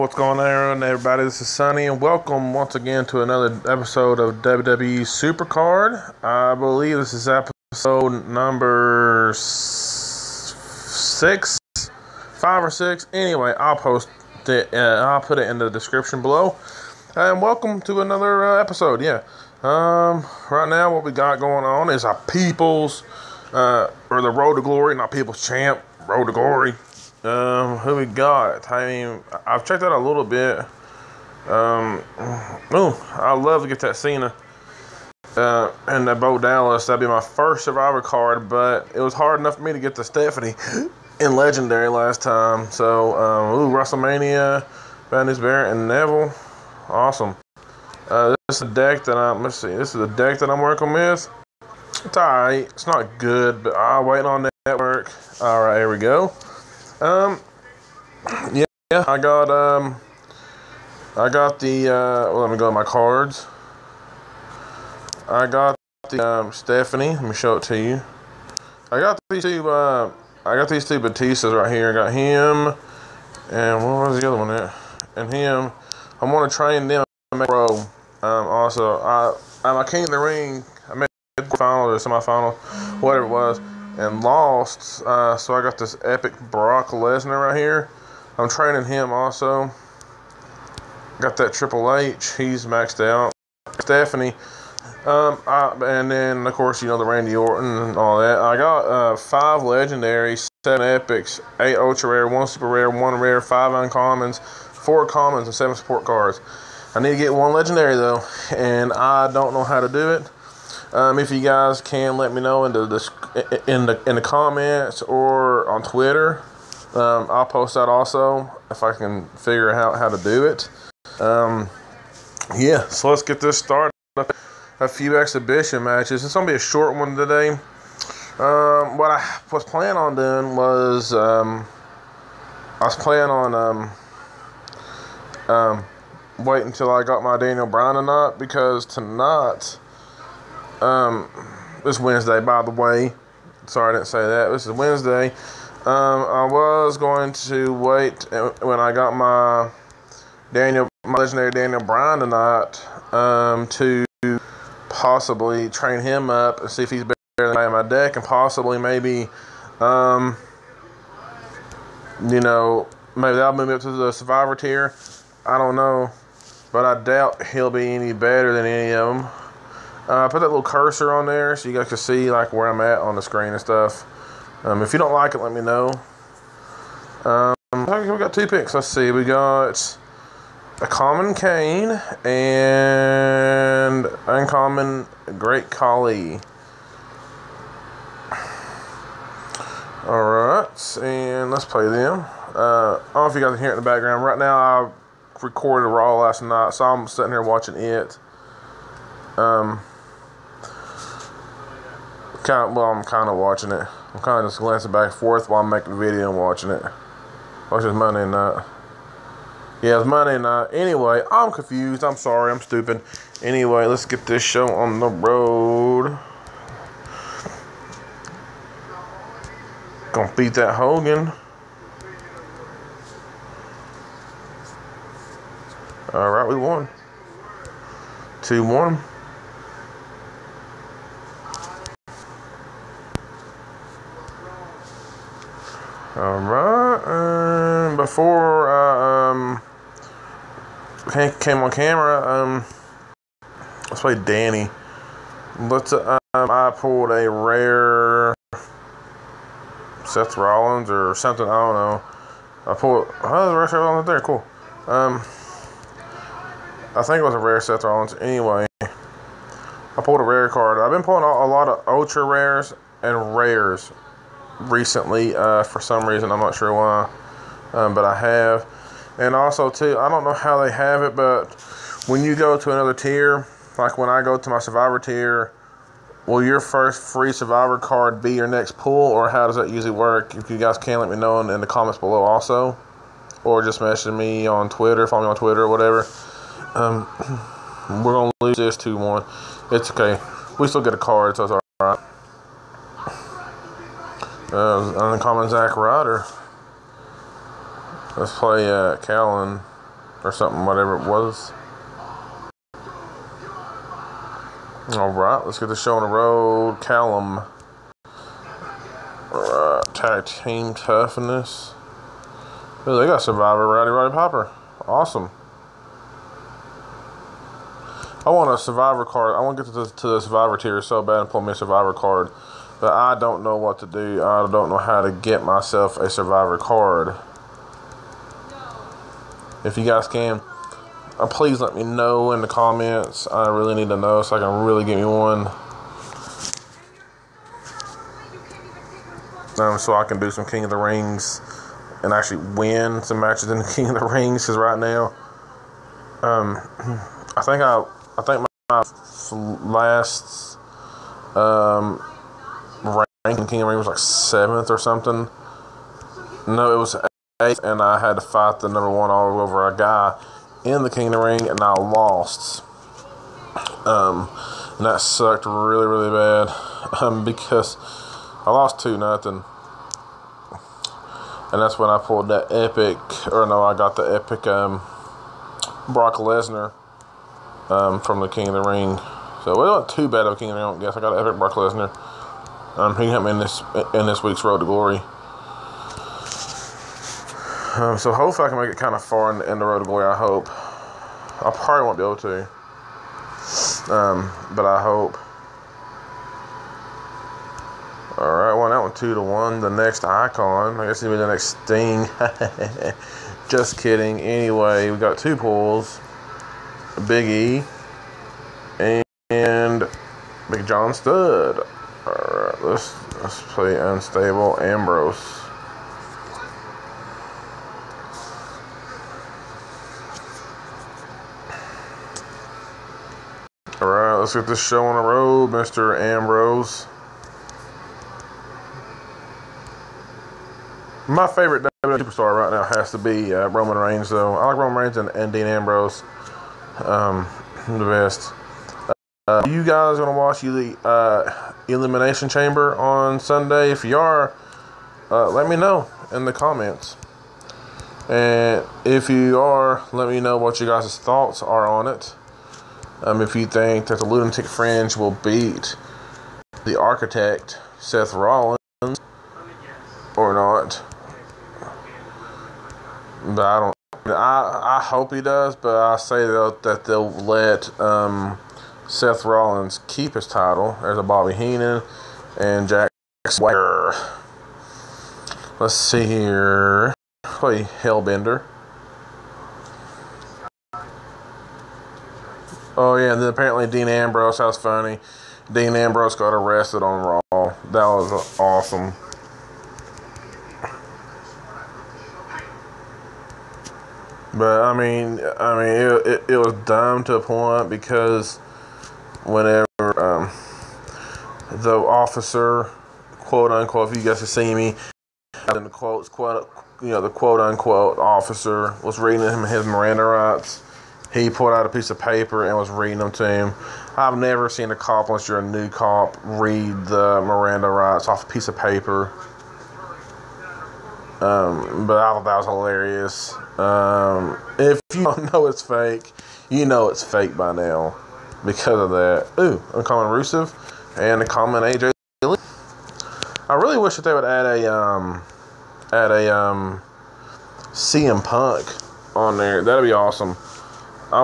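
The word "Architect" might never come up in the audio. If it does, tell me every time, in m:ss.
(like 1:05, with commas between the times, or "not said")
7:36.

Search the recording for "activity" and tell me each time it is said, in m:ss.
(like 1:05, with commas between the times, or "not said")
not said.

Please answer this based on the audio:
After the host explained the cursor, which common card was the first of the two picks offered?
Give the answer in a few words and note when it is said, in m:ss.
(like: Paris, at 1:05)
Kane, at 3:01.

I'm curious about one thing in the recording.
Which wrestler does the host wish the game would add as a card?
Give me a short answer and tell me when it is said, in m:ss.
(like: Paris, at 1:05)
CM Punk, at 8:57.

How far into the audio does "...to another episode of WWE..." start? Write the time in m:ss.
0:03.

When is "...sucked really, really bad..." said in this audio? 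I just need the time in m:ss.
6:05.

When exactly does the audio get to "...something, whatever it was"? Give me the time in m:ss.
5:00.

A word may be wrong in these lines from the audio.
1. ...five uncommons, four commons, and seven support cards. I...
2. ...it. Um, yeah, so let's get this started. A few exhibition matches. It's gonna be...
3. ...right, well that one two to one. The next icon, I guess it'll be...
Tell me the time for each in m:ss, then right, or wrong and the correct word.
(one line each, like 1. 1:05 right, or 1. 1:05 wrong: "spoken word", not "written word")
1. 1:43 right
2. 2:00 right
3. 6:38 right.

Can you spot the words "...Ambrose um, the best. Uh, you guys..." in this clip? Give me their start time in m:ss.
7:15.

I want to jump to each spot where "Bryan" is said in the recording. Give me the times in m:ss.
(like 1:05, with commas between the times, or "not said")
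2:17, 2:31.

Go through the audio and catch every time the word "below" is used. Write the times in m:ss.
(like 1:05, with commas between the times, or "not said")
0:16, 4:41.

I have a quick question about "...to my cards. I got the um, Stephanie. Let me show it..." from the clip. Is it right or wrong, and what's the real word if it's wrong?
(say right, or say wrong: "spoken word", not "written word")
right.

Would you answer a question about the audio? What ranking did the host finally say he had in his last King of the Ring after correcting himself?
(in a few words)
8th.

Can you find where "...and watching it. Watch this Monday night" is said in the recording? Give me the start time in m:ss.
3:26.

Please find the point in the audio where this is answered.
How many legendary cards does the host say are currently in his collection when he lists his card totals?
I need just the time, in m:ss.
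1:39.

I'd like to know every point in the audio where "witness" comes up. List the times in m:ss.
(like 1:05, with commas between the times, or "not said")
not said.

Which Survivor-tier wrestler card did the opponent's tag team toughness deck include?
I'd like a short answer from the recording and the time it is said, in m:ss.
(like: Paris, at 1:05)
Rowdy Roddy Piper, at 5:13.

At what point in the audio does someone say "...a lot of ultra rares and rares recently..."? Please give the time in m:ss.
4:21.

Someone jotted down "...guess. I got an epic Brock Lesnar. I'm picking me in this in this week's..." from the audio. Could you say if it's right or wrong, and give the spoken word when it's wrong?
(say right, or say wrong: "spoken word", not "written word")
right.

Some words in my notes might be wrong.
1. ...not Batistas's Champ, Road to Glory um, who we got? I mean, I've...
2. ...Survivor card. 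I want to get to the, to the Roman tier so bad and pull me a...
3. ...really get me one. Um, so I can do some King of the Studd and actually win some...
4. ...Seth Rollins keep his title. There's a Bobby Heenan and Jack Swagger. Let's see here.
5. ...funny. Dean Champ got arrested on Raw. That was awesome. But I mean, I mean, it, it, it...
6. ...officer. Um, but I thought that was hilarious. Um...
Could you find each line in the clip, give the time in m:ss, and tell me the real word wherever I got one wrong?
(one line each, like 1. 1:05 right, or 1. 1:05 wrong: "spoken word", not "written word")
1. 0:24 wrong: "People", not "Batistas"
2. 5:18 wrong: "Survivor", not "Roman"
3. 5:34 wrong: "Rings", not "Studd"
4. 7:48 right
5. 8:04 wrong: "Ambrose", not "Champ"
6. 8:38 wrong: "paper", not "officer".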